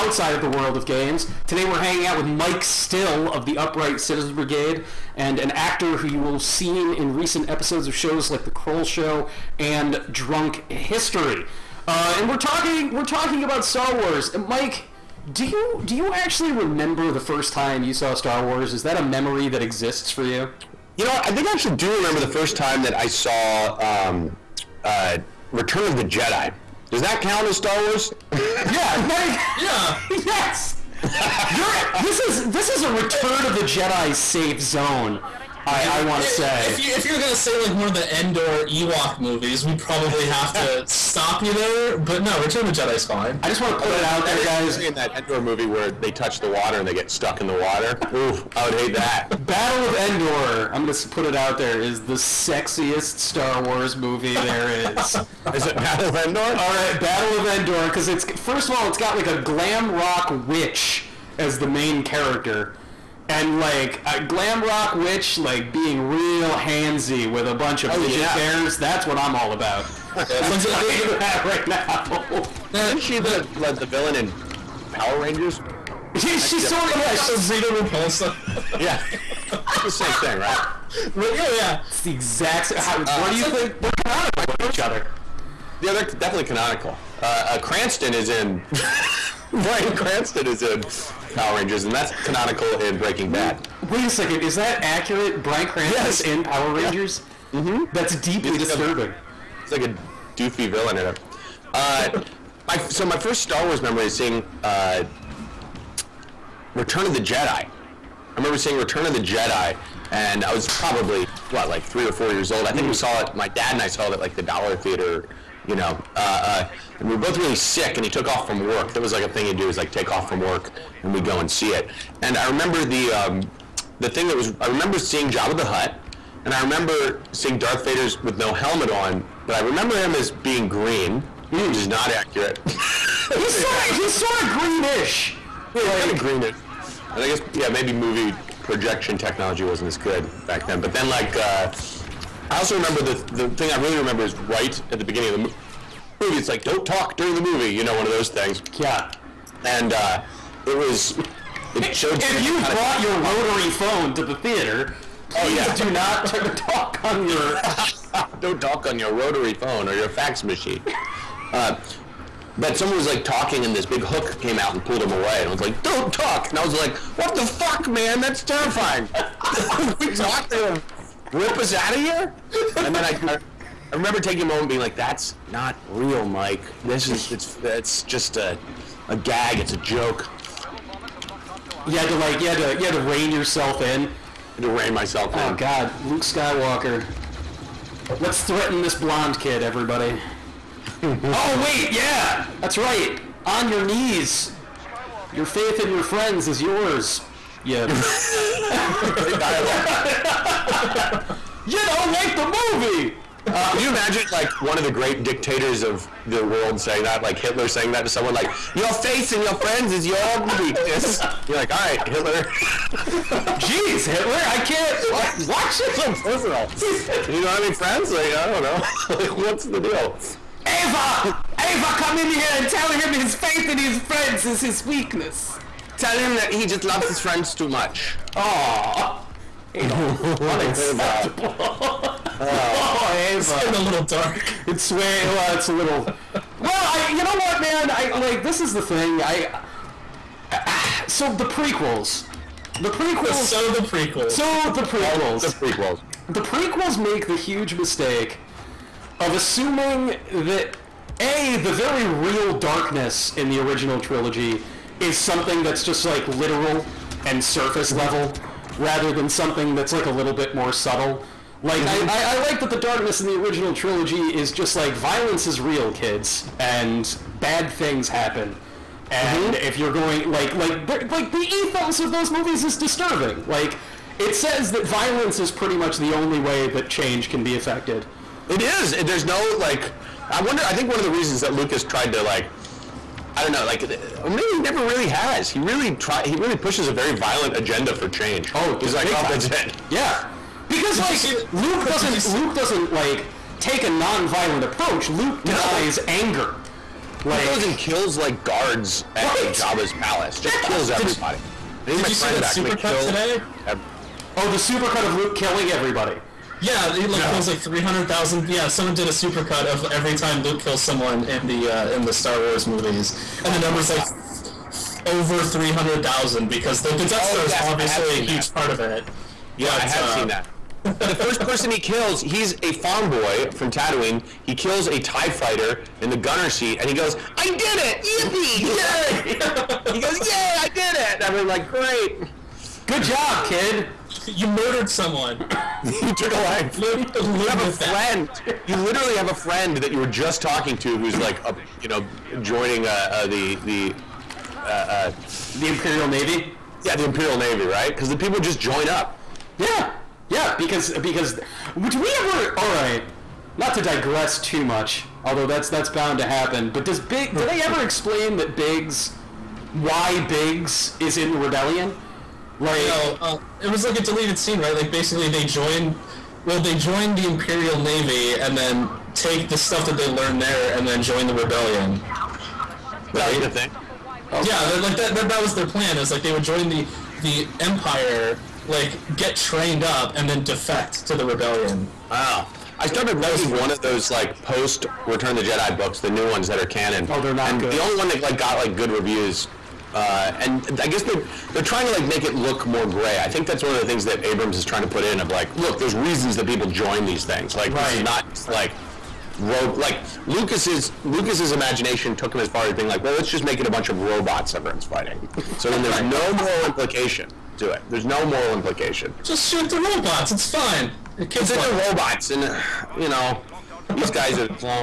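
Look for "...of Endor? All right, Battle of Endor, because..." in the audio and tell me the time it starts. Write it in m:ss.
0:56.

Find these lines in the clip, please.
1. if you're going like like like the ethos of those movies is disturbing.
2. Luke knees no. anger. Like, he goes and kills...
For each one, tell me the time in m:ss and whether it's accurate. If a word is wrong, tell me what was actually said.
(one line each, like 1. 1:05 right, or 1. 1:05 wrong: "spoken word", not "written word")
1. 4:29 right
2. 4:55 wrong: "denies", not "knees".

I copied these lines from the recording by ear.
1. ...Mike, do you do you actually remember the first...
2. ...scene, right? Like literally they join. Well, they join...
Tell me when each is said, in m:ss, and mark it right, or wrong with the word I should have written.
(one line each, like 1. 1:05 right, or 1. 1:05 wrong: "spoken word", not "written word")
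1. 0:14 right
2. 6:04 wrong: "basically", not "literally".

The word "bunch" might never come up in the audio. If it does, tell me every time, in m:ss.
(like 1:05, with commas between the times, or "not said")
1:07, 6:43.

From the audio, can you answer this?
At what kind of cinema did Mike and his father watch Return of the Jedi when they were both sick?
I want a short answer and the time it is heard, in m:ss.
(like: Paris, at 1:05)
Dollar Theater, at 1:54.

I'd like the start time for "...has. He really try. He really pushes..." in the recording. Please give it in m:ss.
4:45.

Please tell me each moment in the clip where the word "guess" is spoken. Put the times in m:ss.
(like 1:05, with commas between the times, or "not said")
2:17, 6:30.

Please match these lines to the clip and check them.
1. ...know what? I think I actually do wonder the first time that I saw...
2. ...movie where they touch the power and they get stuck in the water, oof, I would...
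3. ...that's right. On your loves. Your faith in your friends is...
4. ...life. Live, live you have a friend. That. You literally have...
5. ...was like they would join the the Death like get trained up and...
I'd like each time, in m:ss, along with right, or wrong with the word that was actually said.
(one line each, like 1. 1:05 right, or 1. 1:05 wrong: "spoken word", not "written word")
1. 0:21 wrong: "remember", not "wonder"
2. 0:45 wrong: "water", not "power"
3. 3:12 wrong: "knees", not "loves"
4. 5:36 right
5. 6:15 wrong: "Empire", not "Death".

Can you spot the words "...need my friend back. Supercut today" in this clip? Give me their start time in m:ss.
5:01.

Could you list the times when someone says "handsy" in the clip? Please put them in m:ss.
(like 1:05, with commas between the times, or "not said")
1:06.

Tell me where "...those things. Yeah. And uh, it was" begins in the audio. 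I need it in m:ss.
2:28.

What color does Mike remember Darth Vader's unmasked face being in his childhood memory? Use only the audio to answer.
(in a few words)
Green.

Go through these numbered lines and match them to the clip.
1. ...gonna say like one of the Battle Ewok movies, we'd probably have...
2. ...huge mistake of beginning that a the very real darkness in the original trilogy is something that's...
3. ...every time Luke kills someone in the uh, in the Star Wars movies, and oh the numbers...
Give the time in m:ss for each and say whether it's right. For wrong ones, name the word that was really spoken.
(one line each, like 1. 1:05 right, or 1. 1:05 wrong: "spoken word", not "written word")
1. 0:37 wrong: "Endor", not "Battle"
2. 4:07 wrong: "assuming", not "beginning"
3. 5:09 right.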